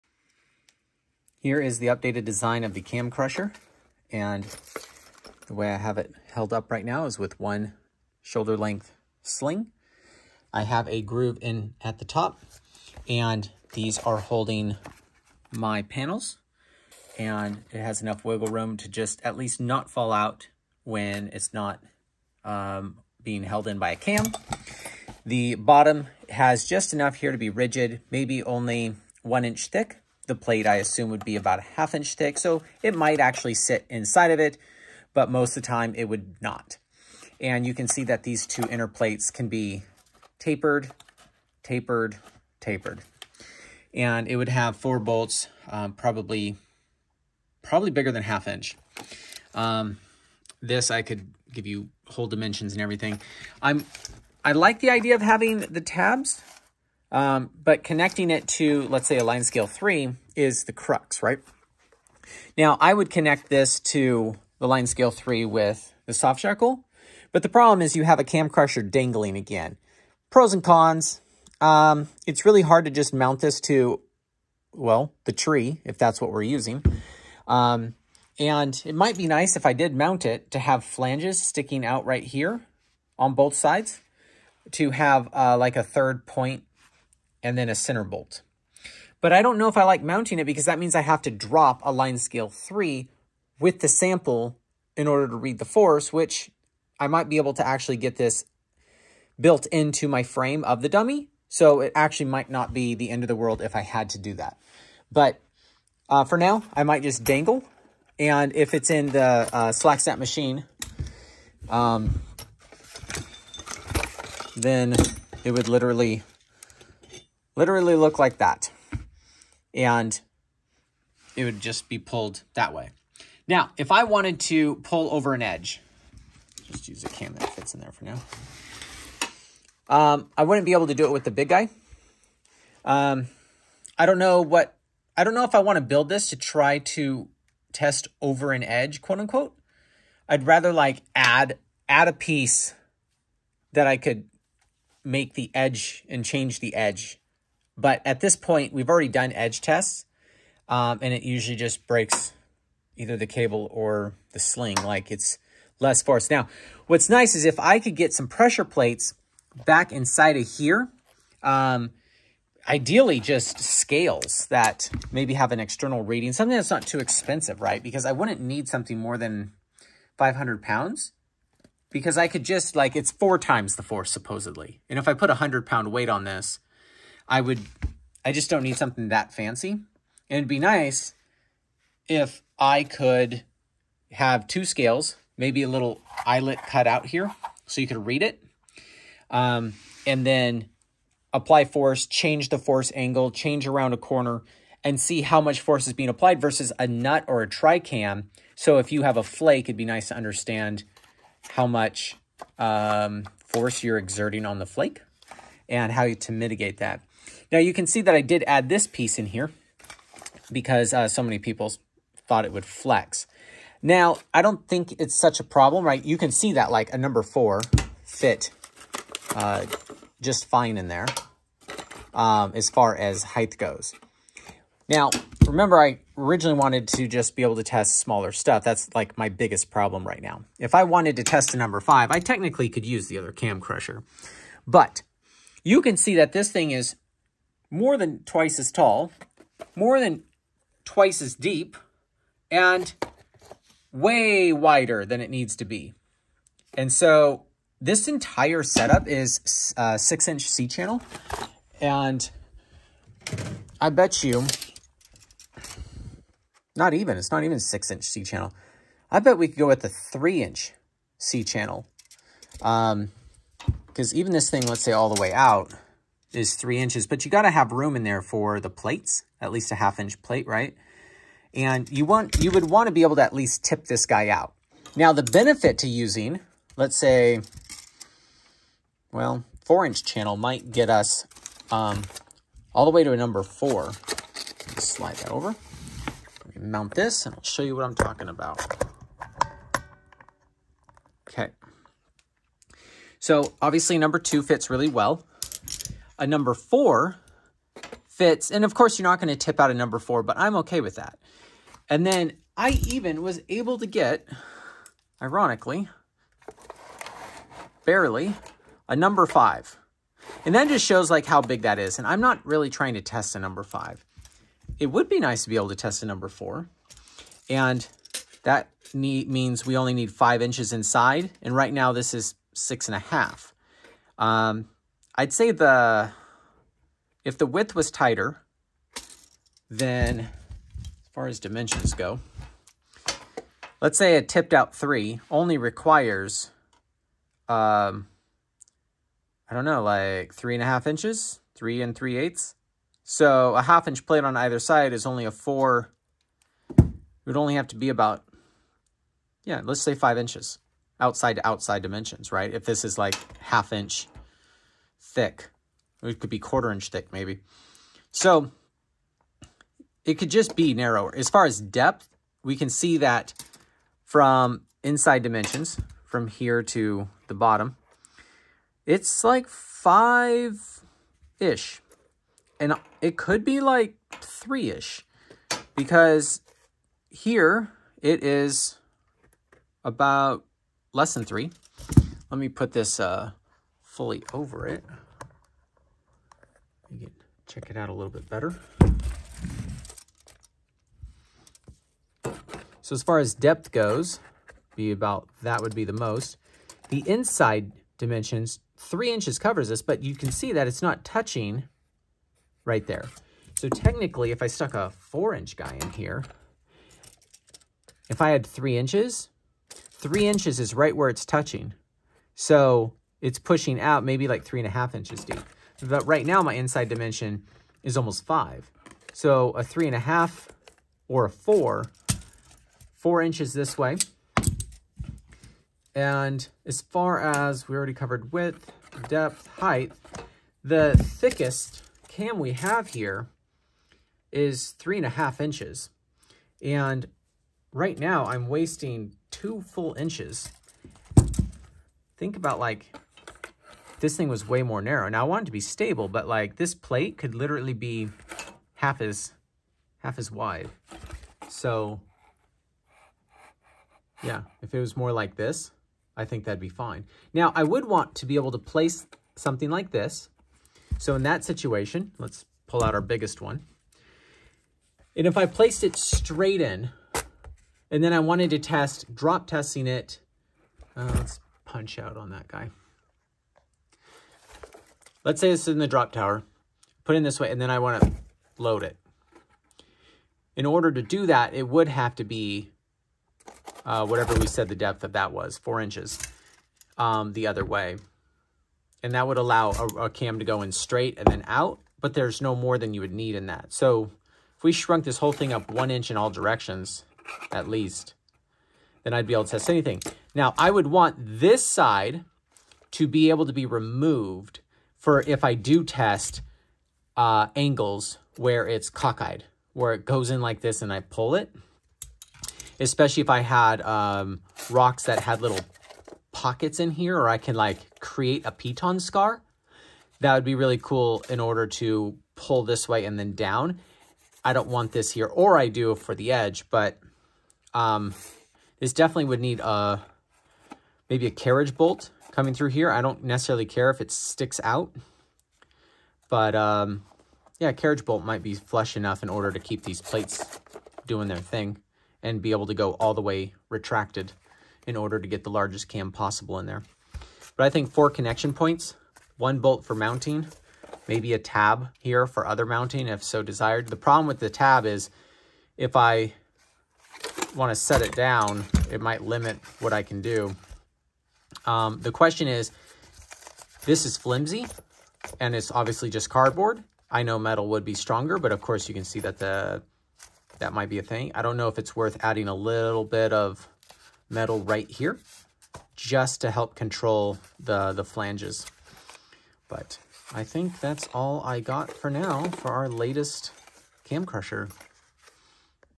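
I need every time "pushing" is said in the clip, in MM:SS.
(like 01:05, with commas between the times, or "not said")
06:53.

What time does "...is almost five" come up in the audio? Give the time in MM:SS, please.
06:57.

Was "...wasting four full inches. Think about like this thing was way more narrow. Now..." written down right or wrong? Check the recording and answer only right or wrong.
wrong.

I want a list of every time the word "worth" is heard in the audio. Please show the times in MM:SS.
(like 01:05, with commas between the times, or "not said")
09:31.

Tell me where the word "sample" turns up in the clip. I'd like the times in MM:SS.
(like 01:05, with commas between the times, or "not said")
01:33.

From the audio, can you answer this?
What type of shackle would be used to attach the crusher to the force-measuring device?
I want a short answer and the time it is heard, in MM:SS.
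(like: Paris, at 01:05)
soft shackle, at 01:06.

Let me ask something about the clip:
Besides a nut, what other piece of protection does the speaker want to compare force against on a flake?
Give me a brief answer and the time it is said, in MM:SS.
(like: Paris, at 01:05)
tricam, at 03:17.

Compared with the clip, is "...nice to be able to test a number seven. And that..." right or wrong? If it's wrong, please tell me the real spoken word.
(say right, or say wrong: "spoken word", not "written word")
wrong: "four", not "seven".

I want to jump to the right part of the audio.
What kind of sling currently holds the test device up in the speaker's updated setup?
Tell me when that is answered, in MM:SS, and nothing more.
00:08.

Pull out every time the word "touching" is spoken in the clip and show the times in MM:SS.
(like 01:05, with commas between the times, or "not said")
06:41, 06:51.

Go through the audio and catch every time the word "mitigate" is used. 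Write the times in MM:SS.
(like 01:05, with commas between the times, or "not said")
03:26.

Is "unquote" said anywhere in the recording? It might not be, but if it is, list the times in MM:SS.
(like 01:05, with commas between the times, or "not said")
02:19.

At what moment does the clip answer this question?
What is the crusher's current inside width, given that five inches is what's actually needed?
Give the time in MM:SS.
05:22.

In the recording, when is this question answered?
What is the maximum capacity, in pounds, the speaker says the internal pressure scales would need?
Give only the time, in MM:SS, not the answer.
02:50.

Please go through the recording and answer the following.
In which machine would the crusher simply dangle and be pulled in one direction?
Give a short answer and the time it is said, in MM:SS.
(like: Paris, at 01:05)
slack snap machine, at 01:49.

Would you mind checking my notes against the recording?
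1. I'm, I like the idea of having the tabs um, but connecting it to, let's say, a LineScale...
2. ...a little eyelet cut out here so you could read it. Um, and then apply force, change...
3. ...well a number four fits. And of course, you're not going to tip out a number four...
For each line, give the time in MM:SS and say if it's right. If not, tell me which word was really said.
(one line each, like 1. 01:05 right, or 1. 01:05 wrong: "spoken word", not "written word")
1. 00:53 right
2. 03:05 right
3. 04:54 right.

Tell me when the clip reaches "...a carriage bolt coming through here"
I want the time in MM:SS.
08:51.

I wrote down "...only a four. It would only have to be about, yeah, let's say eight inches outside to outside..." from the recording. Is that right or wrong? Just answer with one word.
wrong.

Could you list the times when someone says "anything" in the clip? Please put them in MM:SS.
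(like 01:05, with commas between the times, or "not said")
08:19.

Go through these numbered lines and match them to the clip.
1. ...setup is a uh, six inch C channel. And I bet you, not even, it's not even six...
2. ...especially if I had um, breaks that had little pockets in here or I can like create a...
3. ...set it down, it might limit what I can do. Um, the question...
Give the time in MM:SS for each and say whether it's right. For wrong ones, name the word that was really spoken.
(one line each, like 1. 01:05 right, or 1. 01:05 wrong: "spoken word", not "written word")
1. 04:08 right
2. 08:32 wrong: "rocks", not "breaks"
3. 09:17 right.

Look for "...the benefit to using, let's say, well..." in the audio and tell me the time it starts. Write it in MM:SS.
04:35.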